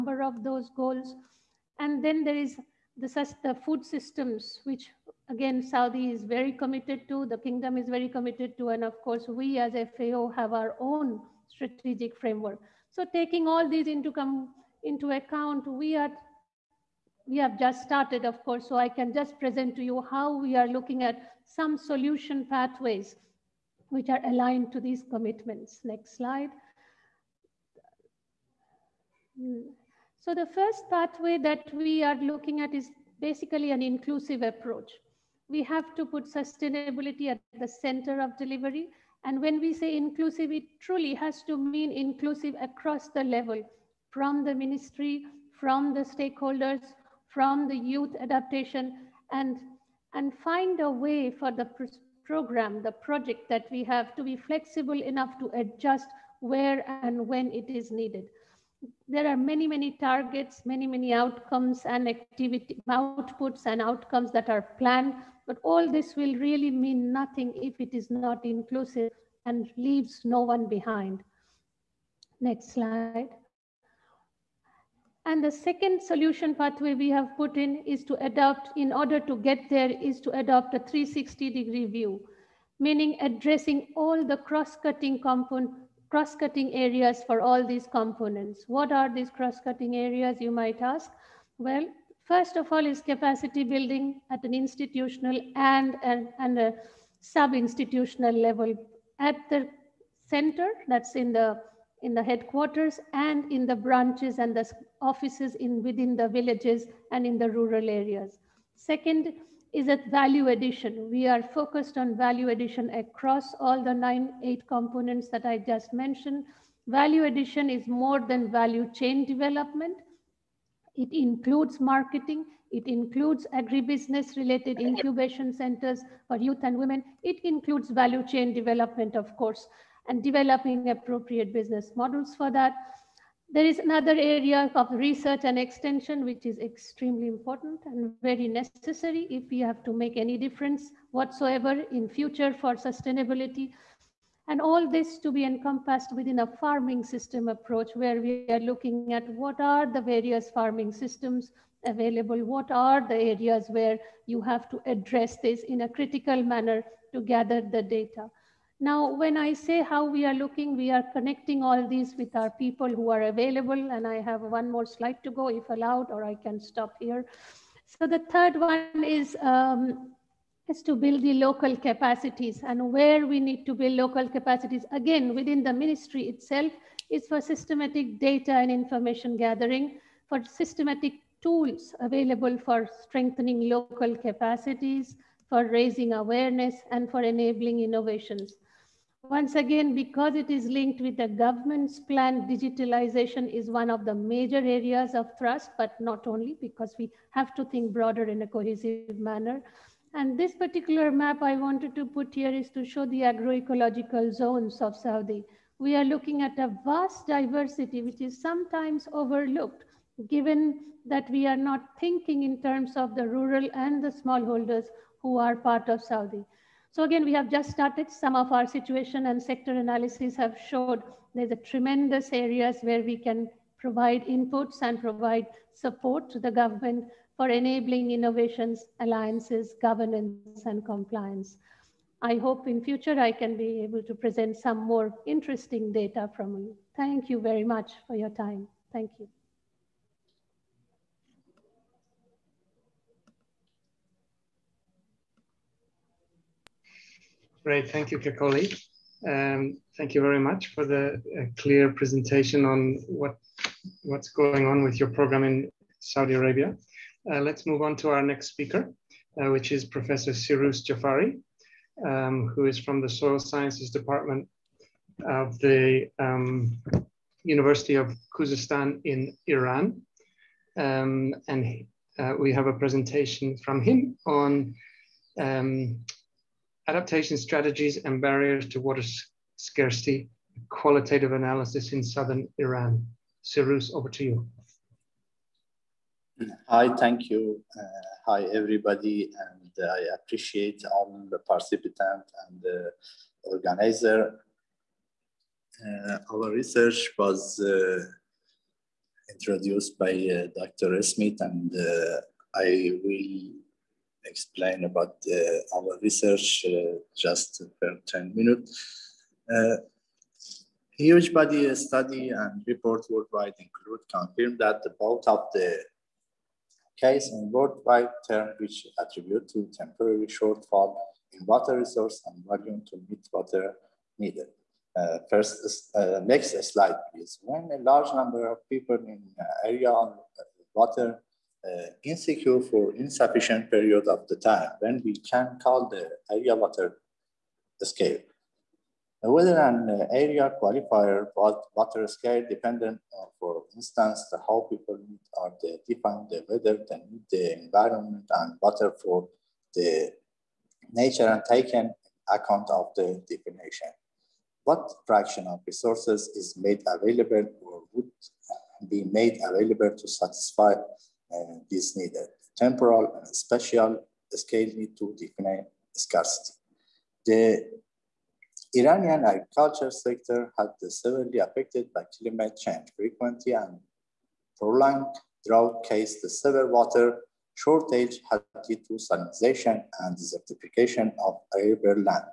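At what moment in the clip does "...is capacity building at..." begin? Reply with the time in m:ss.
1:32.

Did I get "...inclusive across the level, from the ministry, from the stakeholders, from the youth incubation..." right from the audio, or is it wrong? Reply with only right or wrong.
wrong.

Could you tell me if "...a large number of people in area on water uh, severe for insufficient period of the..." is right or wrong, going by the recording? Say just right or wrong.
wrong.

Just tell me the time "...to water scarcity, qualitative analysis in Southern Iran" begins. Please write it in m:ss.
4:38.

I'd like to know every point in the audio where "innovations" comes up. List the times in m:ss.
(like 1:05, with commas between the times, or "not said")
3:07, 3:48.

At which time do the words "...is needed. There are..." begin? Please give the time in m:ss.
0:57.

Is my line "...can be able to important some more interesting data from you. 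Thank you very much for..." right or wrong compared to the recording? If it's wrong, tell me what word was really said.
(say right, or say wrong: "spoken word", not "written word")
wrong: "present", not "important".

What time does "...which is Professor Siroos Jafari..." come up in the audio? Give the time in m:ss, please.
4:19.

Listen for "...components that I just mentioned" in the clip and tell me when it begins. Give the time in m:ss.
1:54.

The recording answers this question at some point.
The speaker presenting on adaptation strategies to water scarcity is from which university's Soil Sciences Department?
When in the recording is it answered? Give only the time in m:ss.
4:27.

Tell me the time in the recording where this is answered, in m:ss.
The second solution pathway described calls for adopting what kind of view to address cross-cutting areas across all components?
1:20.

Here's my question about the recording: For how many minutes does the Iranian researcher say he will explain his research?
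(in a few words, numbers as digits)
10.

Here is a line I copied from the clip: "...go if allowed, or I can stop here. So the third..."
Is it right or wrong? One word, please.
right.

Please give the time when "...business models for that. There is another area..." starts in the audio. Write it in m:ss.
2:11.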